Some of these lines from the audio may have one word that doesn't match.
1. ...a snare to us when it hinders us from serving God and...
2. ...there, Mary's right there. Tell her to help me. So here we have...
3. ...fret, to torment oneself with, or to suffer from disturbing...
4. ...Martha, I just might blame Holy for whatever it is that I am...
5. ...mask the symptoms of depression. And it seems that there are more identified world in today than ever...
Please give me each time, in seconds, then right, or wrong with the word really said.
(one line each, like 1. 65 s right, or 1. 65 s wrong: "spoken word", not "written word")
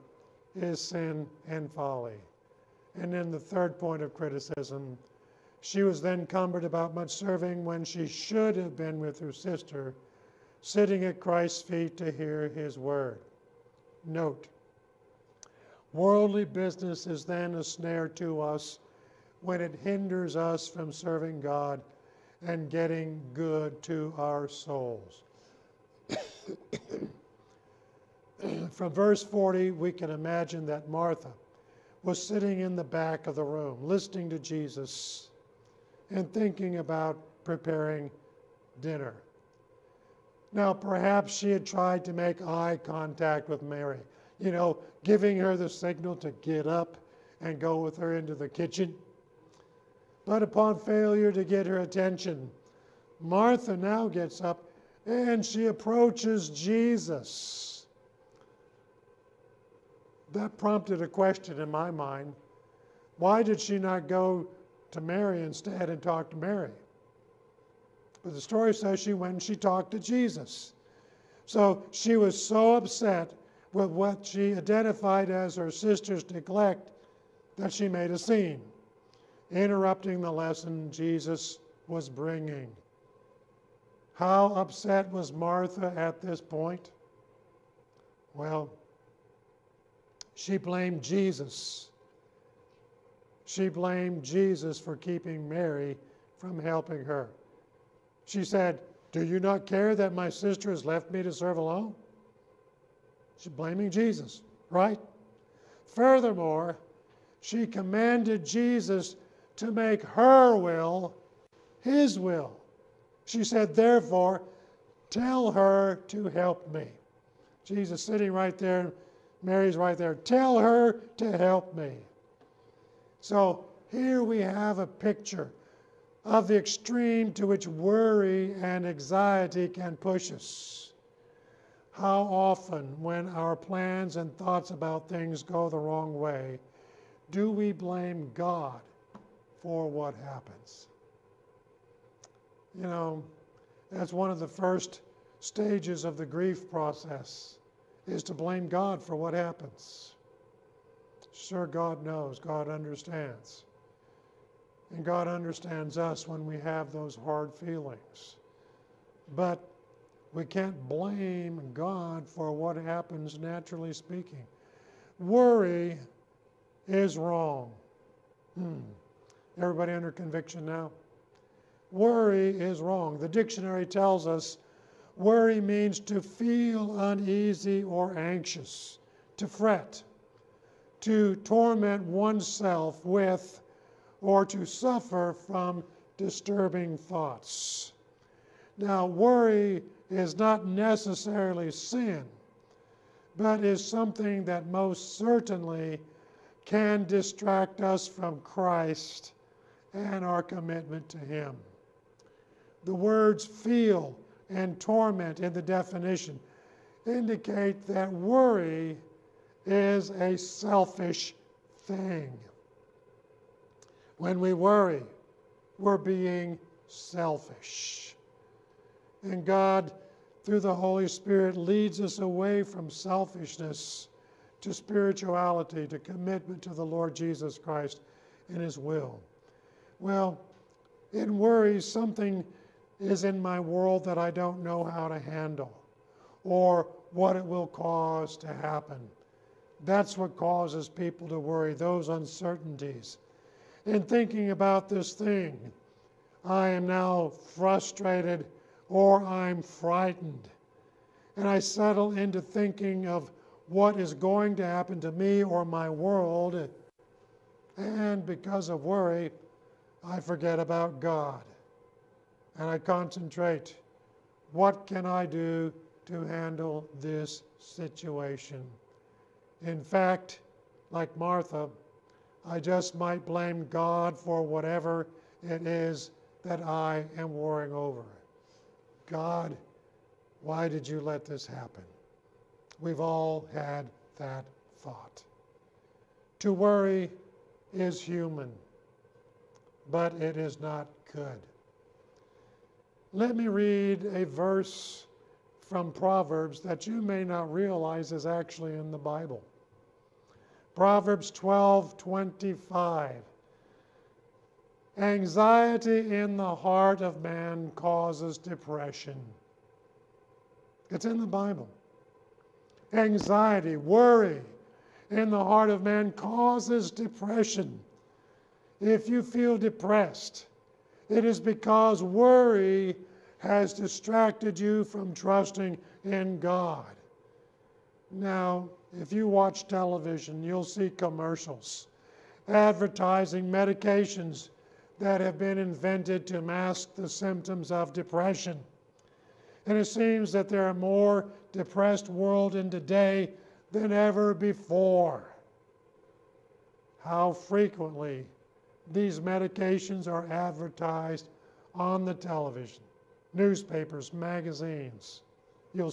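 1. 17 s right
2. 118 s right
3. 179 s right
4. 271 s wrong: "God", not "Holy"
5. 336 s wrong: "depressed", not "identified".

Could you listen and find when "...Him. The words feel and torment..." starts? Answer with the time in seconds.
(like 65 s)
201 s.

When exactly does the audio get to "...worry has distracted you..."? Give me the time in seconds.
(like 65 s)
322 s.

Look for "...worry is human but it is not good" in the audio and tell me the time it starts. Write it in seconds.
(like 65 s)
286 s.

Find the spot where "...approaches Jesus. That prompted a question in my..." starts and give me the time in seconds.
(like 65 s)
55 s.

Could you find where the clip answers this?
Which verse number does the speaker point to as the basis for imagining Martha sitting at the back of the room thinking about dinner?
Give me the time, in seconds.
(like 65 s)
29 s.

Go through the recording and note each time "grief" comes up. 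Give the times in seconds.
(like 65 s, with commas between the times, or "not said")
146 s.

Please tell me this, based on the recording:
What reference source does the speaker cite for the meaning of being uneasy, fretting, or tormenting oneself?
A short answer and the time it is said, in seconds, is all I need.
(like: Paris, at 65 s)
The dictionary, at 173 s.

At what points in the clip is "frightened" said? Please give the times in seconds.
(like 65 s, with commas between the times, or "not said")
249 s.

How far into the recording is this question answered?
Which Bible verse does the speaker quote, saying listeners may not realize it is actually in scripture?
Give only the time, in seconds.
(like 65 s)
300 s.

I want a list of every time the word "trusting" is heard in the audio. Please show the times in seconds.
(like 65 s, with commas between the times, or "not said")
325 s.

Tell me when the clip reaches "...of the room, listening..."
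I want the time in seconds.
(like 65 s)
33 s.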